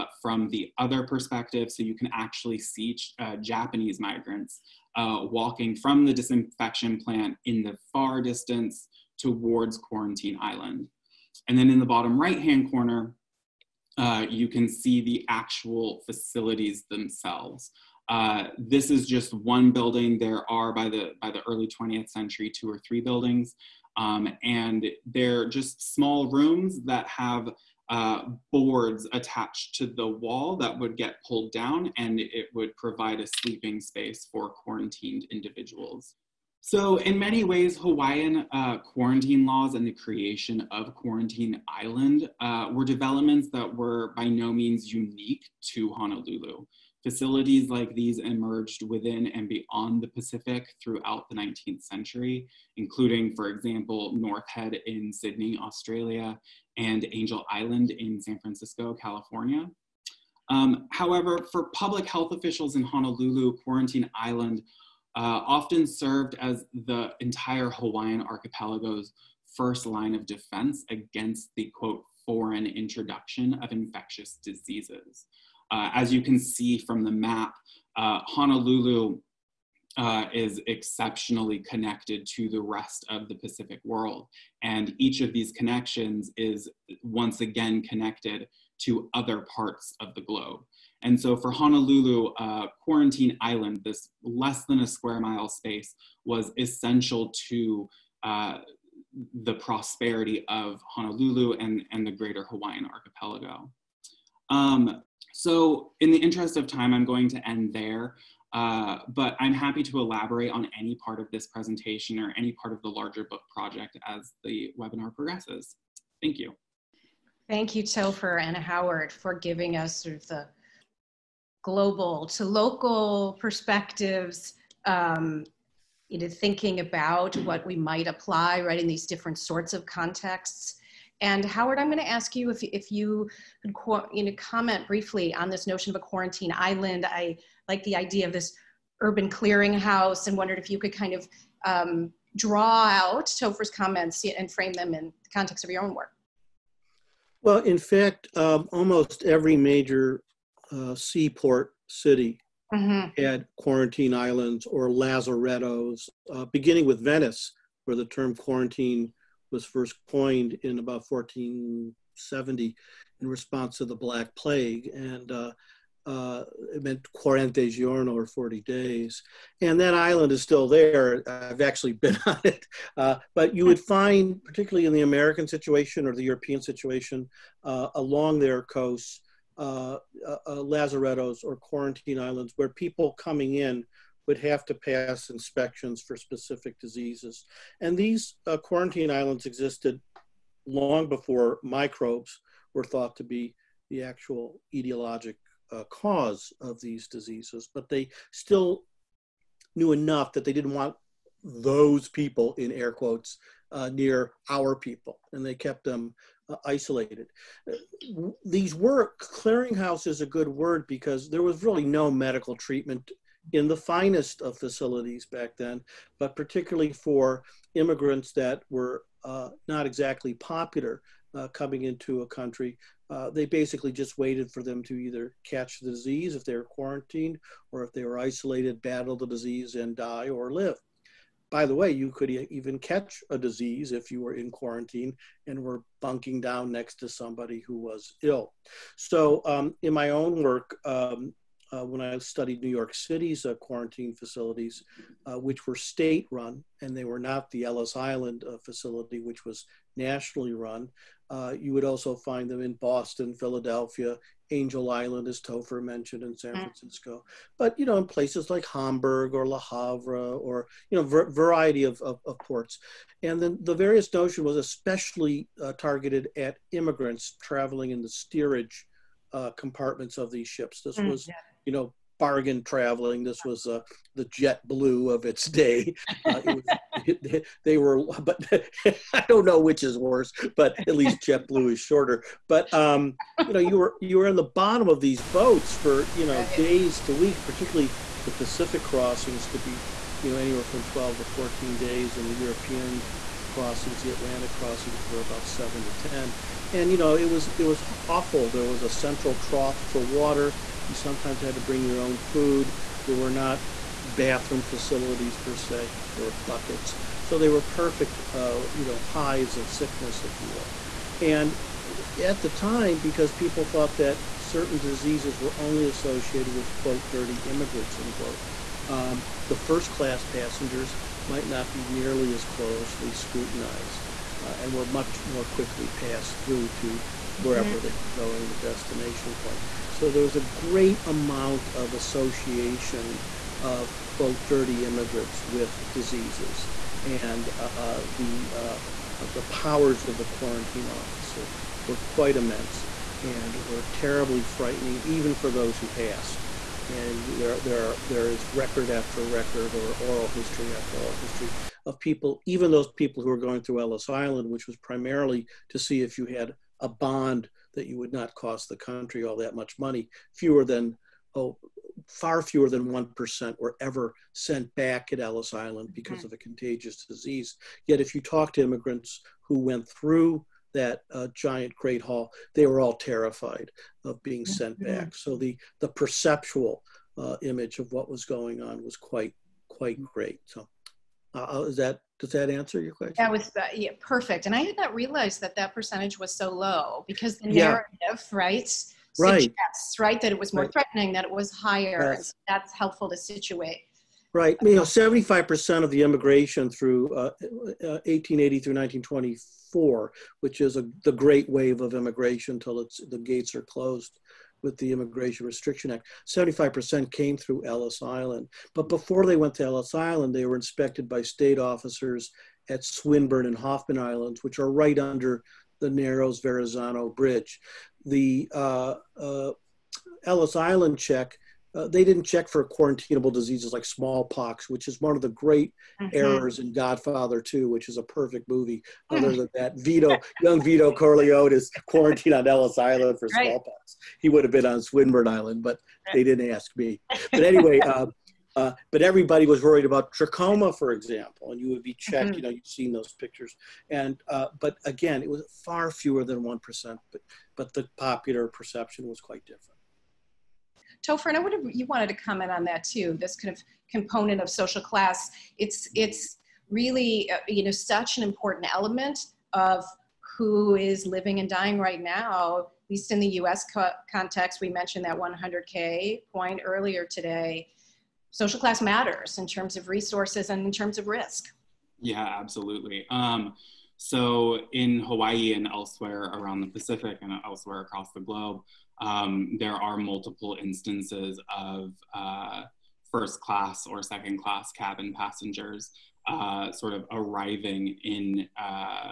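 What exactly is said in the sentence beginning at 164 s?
And uh, uh, it meant Quarante Giorno or 40 days.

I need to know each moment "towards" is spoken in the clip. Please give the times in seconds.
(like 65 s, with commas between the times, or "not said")
9 s.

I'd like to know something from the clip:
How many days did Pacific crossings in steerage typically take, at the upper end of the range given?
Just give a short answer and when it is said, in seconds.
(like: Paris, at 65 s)
14, at 291 s.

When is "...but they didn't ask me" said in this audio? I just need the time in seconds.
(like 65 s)
435 s.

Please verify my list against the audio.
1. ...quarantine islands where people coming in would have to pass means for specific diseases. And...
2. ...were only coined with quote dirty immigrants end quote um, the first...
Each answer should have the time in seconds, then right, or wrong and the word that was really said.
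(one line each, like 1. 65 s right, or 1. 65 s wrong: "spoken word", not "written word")
1. 181 s wrong: "inspections", not "means"
2. 315 s wrong: "associated", not "coined".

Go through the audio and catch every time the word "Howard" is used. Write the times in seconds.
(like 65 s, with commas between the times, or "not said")
118 s, 131 s.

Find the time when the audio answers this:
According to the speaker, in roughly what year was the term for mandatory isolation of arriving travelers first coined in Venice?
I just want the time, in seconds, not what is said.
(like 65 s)
161 s.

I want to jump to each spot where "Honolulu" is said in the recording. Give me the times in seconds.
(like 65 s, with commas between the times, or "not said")
45 s, 62 s, 78 s, 91 s, 100 s.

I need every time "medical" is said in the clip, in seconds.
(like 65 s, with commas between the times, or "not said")
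212 s.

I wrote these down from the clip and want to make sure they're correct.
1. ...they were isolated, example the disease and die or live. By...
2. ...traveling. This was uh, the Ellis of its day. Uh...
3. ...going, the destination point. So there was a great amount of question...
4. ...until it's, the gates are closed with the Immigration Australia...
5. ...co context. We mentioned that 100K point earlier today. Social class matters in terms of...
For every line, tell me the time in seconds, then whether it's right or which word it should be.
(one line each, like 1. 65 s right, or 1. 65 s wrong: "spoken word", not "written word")
1. 227 s wrong: "battle", not "example"
2. 272 s wrong: "JetBlue", not "Ellis"
3. 328 s wrong: "association", not "question"
4. 402 s wrong: "Restriction", not "Australia"
5. 463 s right.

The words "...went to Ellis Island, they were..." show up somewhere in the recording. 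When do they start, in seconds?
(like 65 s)
409 s.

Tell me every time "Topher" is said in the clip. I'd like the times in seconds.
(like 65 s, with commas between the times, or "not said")
117 s, 143 s, 255 s, 451 s.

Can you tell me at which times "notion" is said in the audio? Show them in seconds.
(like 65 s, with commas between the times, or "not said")
135 s, 264 s.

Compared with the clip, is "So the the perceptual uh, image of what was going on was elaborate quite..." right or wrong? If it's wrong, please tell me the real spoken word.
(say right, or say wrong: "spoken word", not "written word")
wrong: "quite", not "elaborate".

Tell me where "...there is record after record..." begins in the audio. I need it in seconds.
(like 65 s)
348 s.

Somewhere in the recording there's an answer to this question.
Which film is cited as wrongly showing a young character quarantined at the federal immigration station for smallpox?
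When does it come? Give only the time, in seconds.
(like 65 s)
426 s.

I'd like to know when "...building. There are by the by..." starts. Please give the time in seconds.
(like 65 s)
19 s.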